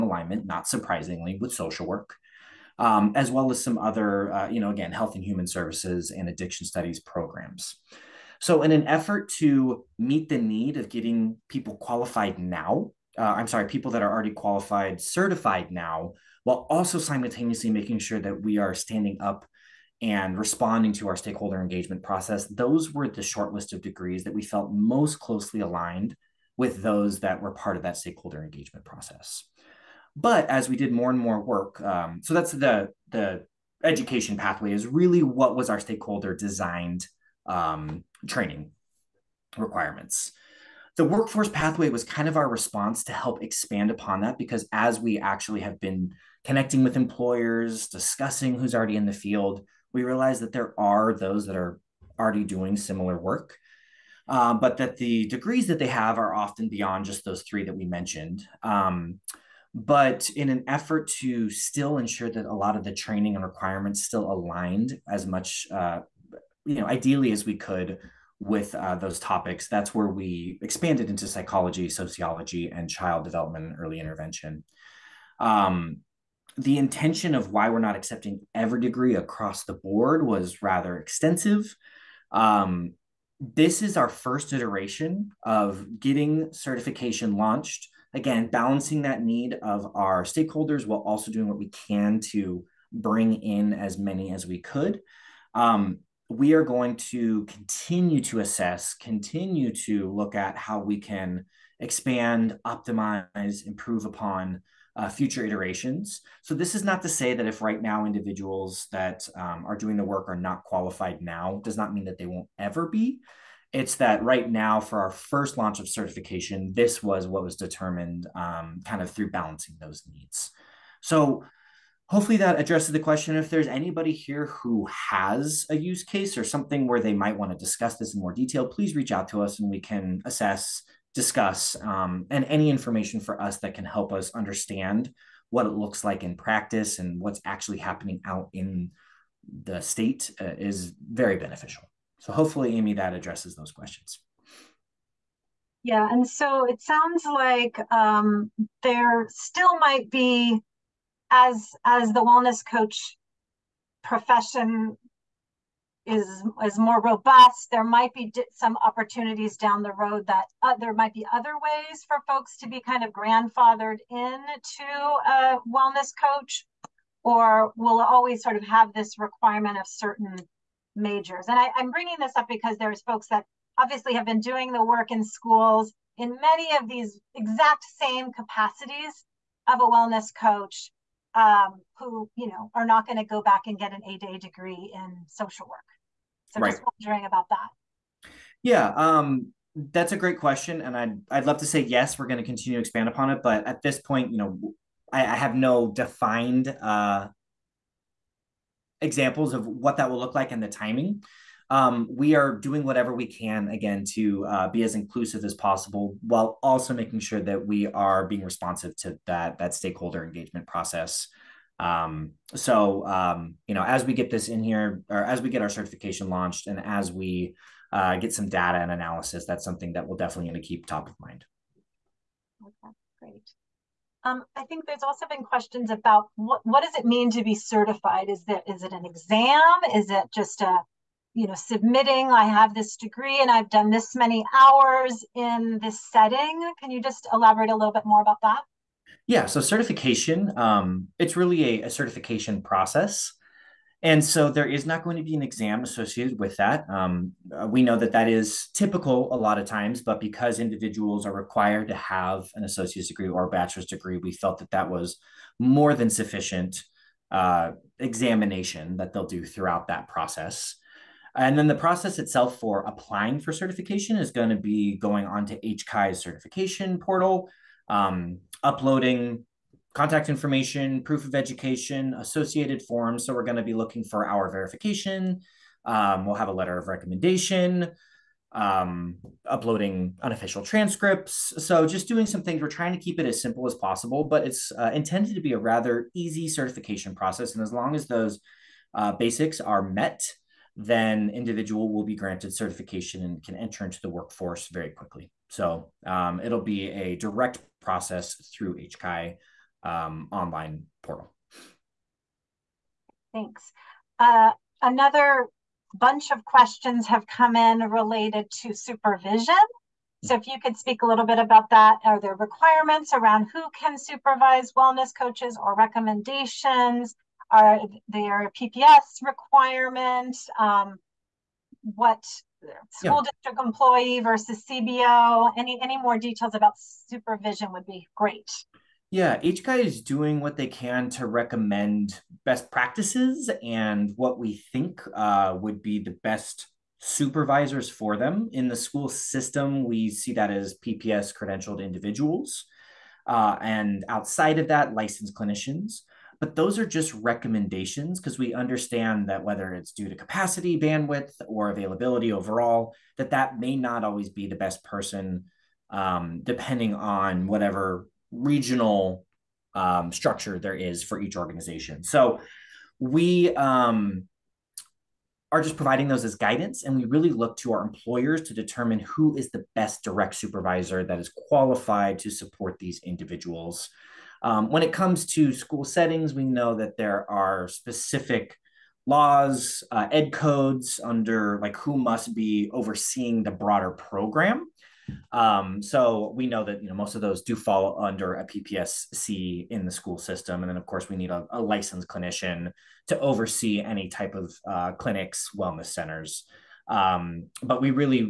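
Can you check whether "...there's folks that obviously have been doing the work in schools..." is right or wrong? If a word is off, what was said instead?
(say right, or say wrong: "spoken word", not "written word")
right.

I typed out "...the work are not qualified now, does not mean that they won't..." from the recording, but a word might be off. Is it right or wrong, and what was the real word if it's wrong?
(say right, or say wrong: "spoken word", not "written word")
right.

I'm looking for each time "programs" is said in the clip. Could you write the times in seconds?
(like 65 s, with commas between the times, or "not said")
7 s, 383 s.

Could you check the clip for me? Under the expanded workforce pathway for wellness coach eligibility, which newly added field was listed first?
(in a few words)
psychology.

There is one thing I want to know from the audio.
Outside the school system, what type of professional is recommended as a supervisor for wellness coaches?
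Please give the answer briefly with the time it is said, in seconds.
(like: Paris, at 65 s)
licensed clinicians, at 344 s.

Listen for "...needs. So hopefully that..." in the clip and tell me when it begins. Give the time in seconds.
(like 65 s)
120 s.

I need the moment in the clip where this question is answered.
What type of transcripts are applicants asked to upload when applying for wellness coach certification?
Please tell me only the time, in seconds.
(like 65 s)
280 s.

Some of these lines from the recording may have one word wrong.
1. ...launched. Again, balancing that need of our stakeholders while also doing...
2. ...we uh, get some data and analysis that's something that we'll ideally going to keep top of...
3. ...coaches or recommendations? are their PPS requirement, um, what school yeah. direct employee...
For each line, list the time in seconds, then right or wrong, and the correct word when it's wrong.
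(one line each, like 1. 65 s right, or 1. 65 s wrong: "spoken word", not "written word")
1. 87 s right
2. 217 s wrong: "definitely", not "ideally"
3. 315 s wrong: "district", not "direct".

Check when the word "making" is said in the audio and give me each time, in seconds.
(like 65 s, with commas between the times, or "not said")
17 s, 206 s.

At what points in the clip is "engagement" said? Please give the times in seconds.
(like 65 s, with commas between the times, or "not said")
21 s, 28 s, 210 s.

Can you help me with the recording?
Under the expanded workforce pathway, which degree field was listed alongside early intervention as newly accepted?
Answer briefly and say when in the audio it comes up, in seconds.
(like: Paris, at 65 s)
child development, at 72 s.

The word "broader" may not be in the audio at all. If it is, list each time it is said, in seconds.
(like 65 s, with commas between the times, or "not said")
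383 s.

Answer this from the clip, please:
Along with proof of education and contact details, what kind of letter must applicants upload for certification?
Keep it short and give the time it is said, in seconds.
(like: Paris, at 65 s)
letter of recommendation, at 276 s.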